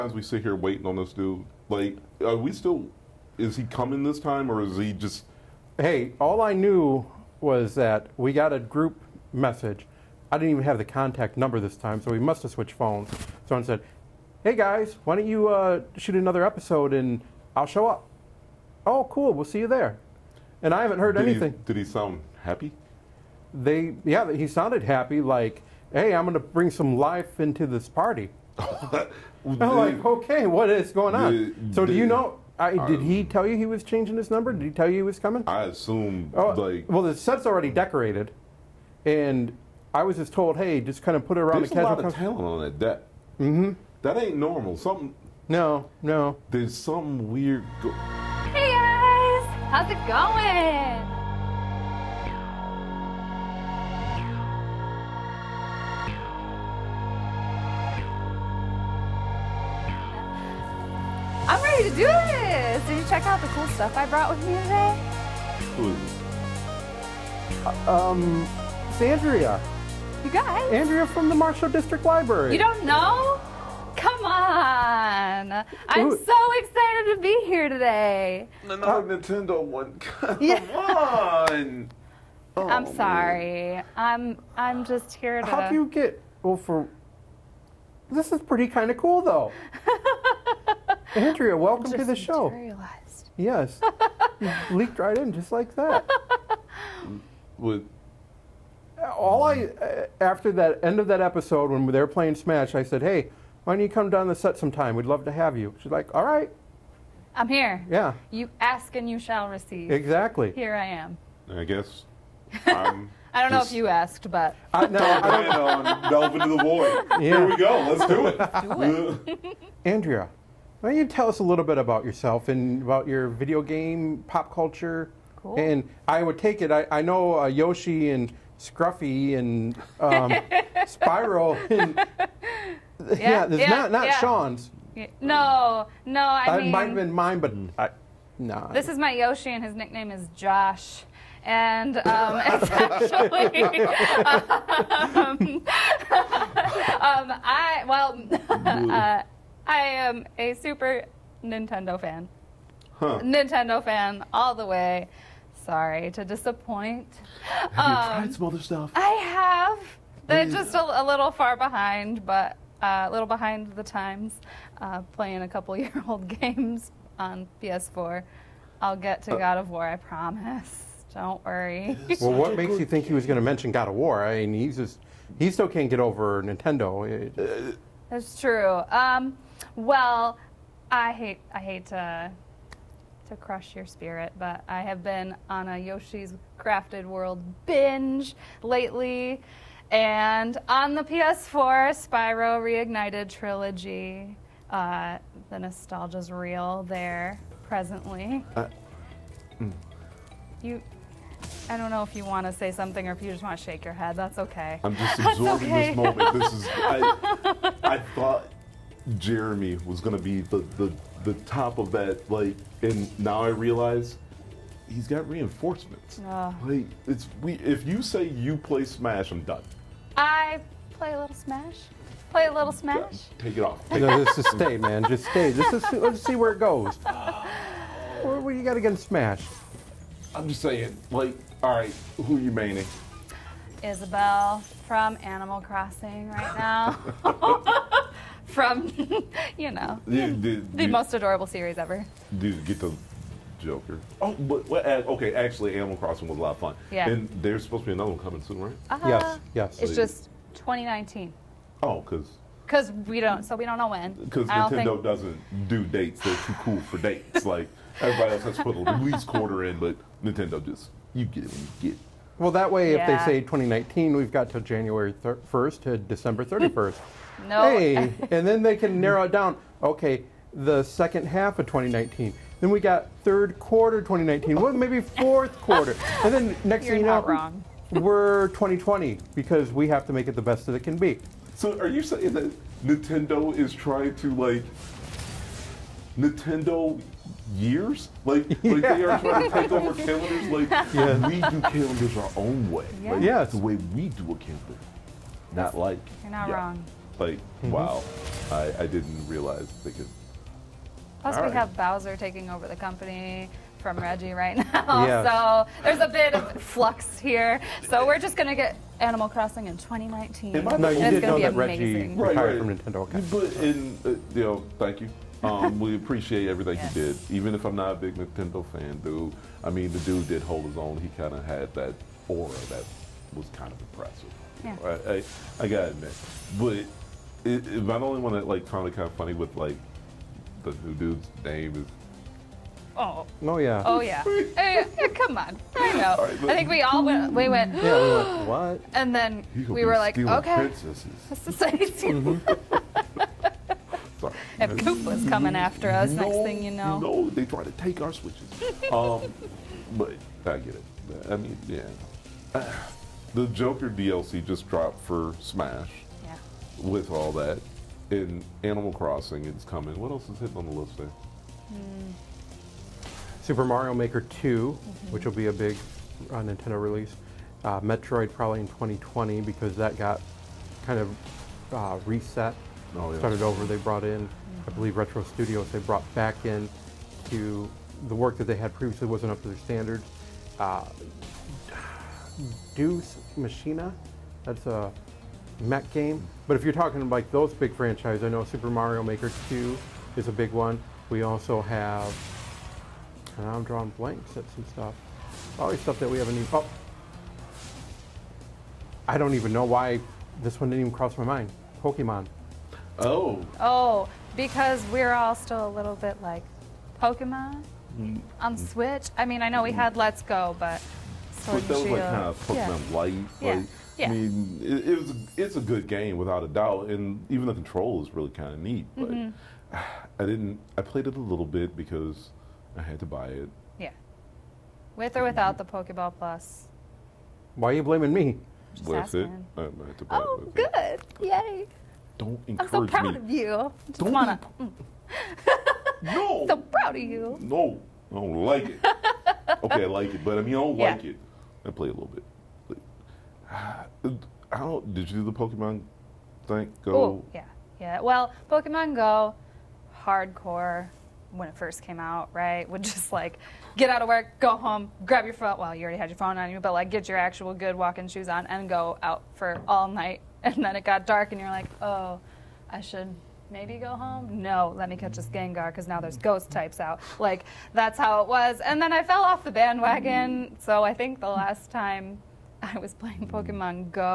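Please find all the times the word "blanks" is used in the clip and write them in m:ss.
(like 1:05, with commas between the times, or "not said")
6:33.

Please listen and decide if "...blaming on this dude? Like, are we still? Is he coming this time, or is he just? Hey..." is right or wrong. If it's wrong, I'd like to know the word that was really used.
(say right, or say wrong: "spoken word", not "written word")
wrong: "waiting", not "blaming".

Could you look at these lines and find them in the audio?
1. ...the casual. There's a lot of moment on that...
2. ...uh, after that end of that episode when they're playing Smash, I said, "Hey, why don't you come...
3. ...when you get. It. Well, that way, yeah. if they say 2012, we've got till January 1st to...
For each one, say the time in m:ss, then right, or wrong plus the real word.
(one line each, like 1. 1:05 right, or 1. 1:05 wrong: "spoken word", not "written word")
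1. 0:41 wrong: "talent", not "moment"
2. 1:39 right
3. 4:21 wrong: "2019", not "2012".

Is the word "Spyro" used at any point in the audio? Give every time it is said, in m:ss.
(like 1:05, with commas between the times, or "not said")
2:10, 3:12.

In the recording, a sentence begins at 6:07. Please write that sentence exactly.
Uh, Metroid probably in 2020 because that got kind of uh, reset.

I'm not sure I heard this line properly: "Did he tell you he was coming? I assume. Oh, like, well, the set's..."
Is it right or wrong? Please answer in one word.
right.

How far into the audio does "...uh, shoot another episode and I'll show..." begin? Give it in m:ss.
0:15.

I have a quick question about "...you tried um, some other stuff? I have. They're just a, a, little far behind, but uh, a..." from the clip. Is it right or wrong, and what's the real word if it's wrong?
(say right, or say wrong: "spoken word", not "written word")
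right.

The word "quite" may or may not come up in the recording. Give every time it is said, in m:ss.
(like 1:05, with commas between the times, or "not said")
not said.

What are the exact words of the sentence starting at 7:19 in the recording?
okay, I like it, but I mean, I don't yeah.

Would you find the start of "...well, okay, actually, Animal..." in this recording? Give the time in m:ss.
4:04.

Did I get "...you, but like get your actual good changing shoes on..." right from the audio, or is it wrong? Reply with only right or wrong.
wrong.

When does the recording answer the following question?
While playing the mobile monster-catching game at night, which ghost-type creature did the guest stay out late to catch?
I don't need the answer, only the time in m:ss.
7:45.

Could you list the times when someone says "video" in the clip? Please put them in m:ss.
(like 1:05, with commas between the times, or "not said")
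2:03.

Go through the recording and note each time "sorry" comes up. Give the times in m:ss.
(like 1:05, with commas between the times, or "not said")
1:22, 2:35.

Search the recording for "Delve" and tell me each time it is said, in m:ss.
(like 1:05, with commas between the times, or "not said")
1:56.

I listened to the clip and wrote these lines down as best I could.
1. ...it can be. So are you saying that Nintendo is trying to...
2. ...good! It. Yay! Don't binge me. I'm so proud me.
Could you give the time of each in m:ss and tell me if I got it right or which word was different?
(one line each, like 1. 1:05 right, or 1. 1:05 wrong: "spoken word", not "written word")
1. 4:40 right
2. 7:10 wrong: "encourage", not "binge".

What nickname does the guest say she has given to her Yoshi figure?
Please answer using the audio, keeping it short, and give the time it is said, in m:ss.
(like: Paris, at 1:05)
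Josh, at 2:20.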